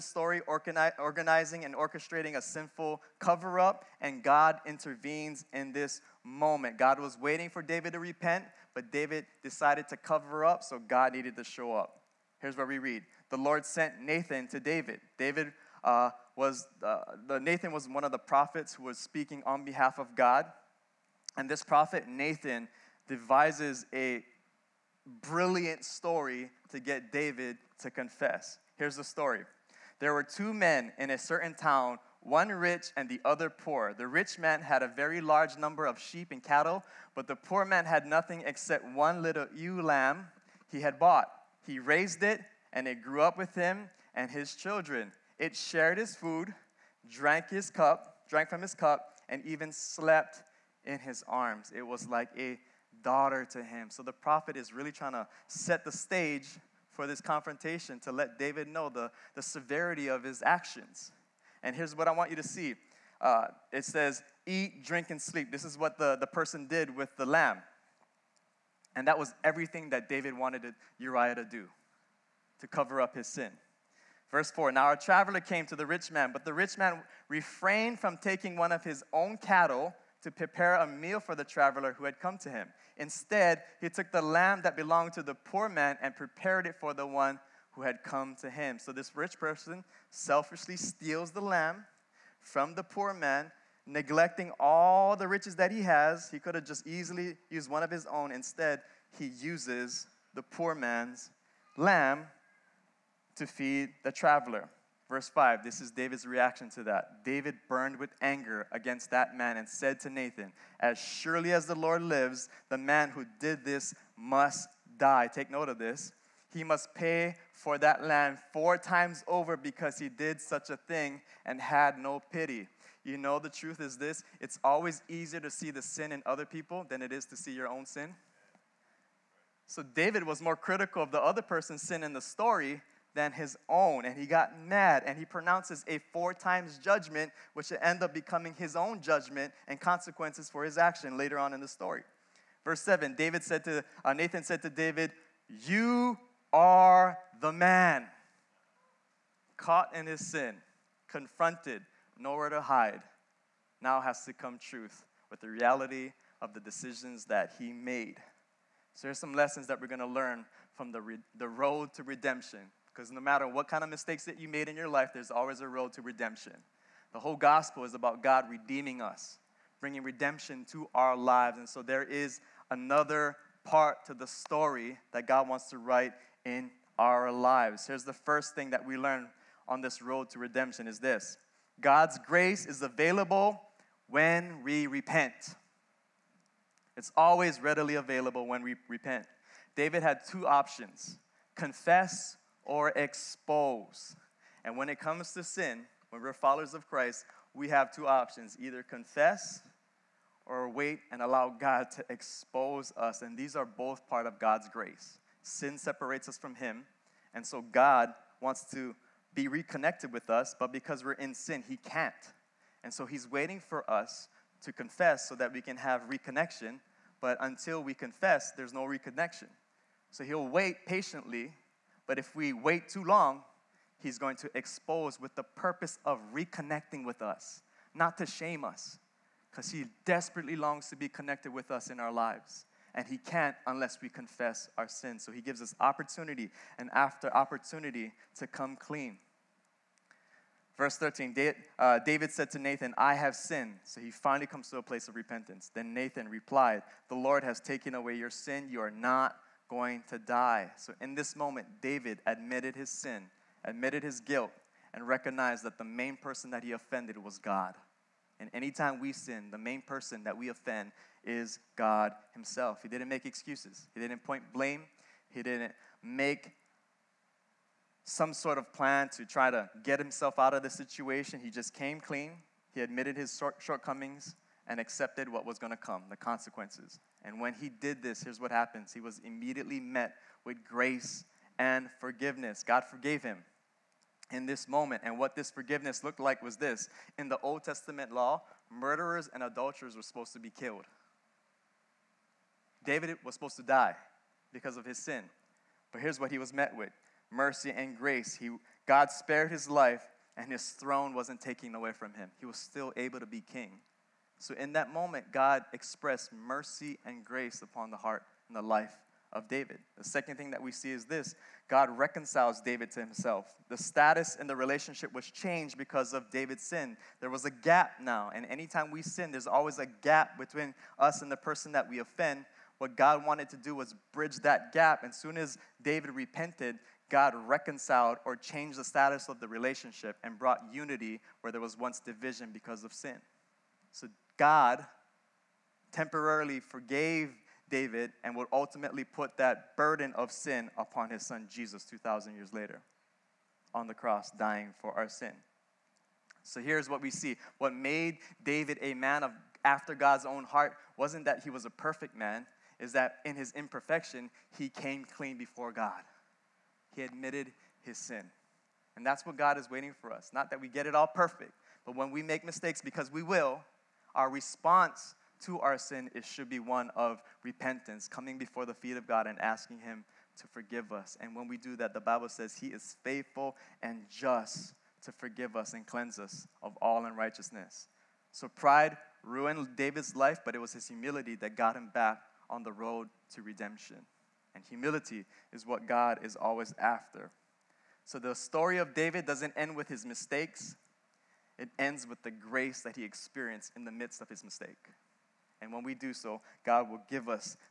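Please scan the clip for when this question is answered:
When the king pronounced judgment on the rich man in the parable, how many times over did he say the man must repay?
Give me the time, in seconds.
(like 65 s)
118 s.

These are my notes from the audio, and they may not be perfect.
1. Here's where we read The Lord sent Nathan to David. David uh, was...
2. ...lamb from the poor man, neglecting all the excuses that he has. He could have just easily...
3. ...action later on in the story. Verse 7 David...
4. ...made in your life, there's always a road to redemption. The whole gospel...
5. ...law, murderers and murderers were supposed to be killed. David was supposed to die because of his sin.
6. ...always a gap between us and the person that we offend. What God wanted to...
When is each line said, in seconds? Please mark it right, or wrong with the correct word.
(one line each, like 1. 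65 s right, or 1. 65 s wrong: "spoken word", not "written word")
1. 12 s right
2. 91 s wrong: "riches", not "excuses"
3. 140 s right
4. 164 s right
5. 288 s wrong: "adulterers", not "murderers"
6. 319 s right.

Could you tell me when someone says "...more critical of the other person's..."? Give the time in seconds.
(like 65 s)
130 s.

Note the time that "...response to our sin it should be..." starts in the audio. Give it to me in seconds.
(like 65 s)
364 s.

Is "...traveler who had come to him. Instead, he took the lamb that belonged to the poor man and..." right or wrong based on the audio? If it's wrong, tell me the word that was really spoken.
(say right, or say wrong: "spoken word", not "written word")
right.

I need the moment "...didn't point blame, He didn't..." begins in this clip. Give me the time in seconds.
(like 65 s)
264 s.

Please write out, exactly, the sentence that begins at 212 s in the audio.
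And so He's waiting for us to confess so that we can have reconnection, but until we confess, there's no reconnection.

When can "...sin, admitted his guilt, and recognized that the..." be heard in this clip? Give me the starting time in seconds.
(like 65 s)
252 s.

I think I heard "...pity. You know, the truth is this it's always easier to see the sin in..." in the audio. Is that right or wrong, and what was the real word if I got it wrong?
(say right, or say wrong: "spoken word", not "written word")
right.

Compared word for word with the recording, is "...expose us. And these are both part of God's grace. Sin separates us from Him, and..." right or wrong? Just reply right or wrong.
right.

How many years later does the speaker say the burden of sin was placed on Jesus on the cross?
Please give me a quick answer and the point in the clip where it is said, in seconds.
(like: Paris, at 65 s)
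2,000, at 341 s.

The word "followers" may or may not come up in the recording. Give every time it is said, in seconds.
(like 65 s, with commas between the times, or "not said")
196 s.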